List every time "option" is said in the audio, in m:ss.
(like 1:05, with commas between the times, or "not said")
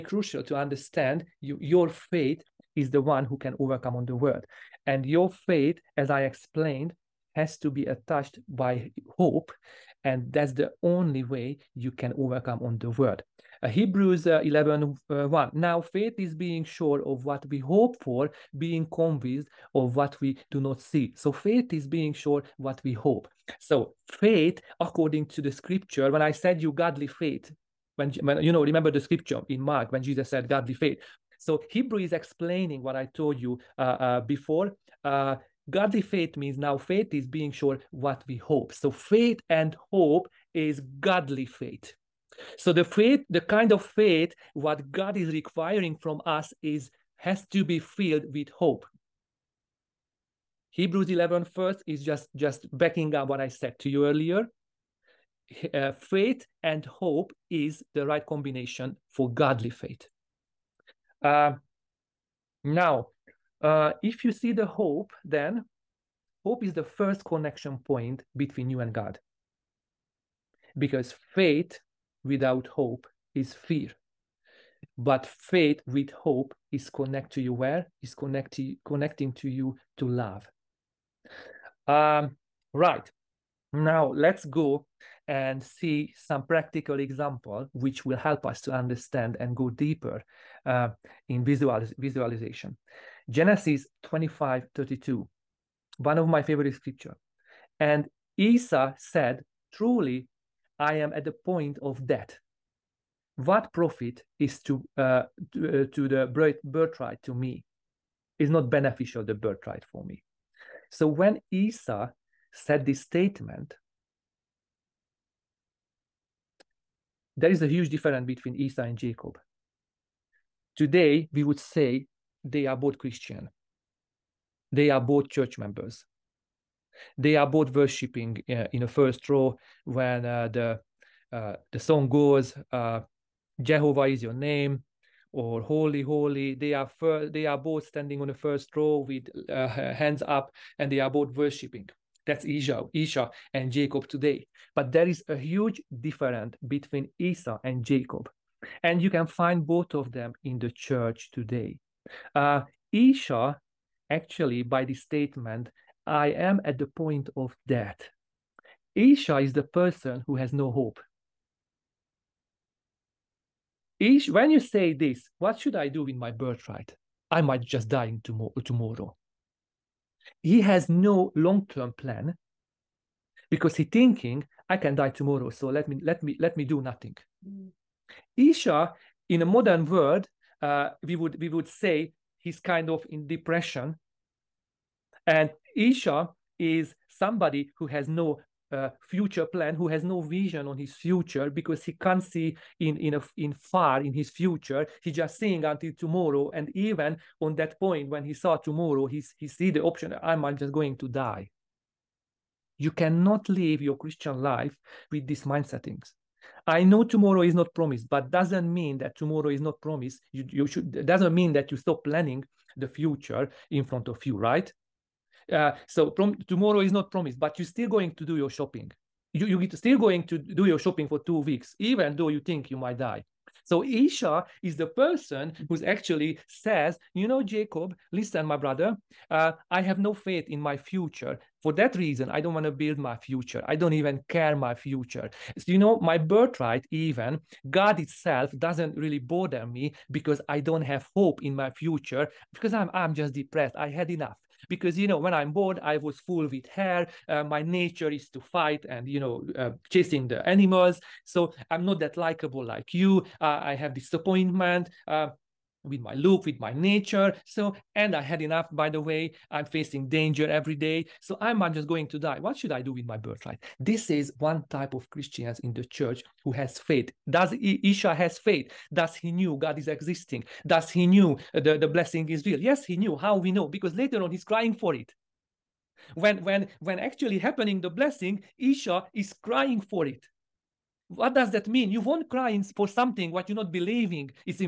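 3:19.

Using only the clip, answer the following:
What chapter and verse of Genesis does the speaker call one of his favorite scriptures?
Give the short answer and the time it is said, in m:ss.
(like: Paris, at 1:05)
25:32, at 1:33.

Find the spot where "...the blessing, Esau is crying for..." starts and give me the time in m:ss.
4:37.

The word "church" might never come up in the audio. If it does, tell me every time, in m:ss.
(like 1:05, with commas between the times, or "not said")
2:05, 2:30, 4:25.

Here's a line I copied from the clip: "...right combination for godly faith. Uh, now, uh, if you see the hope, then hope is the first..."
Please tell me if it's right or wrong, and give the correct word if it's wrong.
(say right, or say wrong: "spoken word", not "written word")
right.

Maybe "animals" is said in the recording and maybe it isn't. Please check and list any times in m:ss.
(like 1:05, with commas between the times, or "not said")
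4:10.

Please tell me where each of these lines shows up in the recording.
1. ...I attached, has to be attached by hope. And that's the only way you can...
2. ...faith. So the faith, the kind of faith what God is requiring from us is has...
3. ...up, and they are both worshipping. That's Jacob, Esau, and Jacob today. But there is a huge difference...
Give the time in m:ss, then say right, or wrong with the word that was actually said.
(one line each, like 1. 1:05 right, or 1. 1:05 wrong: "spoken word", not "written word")
1. 0:06 wrong: "explained", not "attached"
2. 0:41 right
3. 2:20 wrong: "Esau", not "Jacob".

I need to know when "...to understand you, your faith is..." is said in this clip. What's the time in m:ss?
0:00.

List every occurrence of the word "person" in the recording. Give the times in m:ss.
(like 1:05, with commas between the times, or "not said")
2:39, 3:44.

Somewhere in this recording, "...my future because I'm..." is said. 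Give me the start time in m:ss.
4:01.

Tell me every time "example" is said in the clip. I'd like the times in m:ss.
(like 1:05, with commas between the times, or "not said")
1:26.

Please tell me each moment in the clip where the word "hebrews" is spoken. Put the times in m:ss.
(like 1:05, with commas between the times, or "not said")
0:13, 0:31, 0:50.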